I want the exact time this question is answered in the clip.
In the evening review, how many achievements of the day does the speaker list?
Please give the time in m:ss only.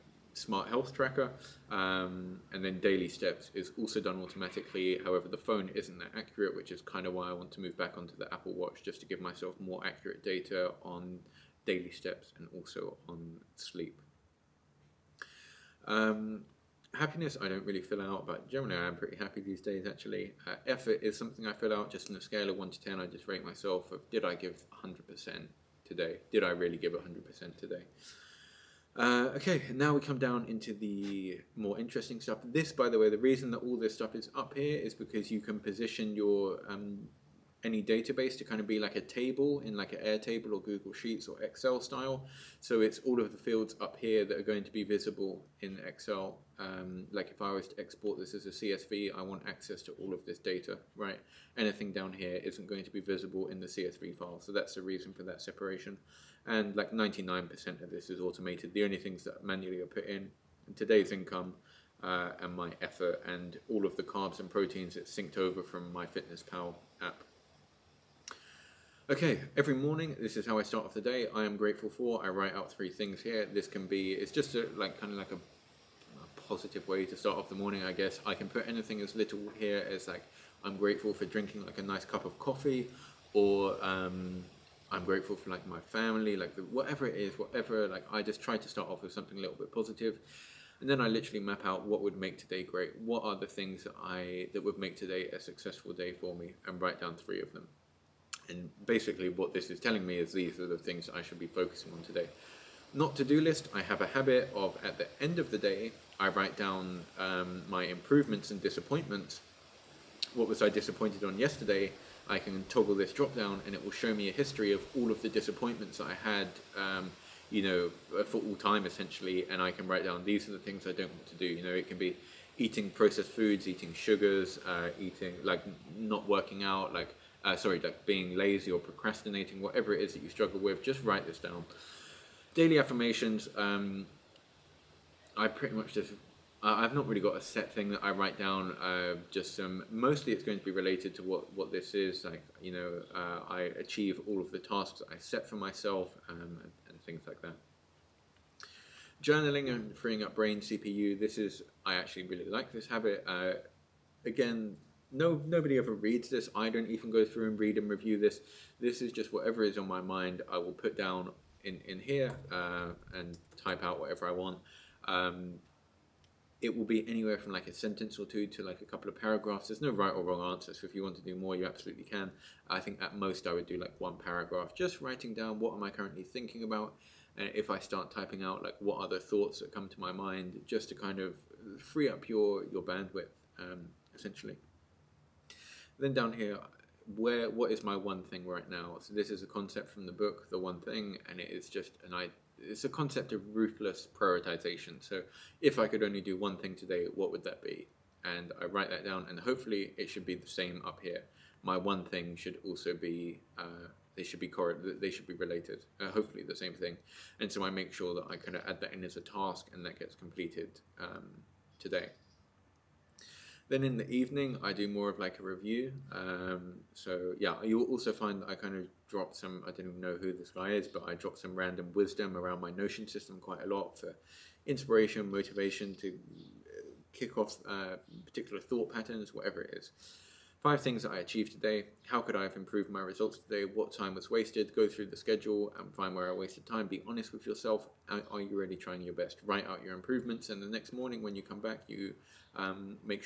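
3:50.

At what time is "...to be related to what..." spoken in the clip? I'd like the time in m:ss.
2:20.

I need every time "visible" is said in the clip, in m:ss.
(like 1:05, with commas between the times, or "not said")
0:44, 0:52.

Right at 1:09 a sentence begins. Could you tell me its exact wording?
Okay, every morning, this is how I start off the day.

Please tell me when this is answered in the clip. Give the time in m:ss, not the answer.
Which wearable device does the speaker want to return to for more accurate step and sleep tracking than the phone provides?
0:08.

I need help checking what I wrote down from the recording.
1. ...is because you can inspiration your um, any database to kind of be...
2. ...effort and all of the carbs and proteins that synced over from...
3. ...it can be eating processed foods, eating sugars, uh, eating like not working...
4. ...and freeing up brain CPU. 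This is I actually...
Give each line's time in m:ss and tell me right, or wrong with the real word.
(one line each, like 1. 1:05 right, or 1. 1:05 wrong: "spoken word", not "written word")
1. 0:34 wrong: "position", not "inspiration"
2. 1:02 right
3. 2:01 right
4. 2:29 right.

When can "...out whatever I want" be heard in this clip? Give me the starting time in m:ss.
2:43.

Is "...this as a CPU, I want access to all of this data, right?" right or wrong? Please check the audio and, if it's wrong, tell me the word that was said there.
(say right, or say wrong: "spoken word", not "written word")
wrong: "CSV", not "CPU".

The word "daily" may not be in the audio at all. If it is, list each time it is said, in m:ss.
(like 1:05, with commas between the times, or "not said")
0:02, 0:11, 2:12.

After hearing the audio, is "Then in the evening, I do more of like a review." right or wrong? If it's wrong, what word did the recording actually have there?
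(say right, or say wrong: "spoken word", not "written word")
right.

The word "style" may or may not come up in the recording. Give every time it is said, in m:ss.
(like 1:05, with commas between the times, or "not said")
0:41.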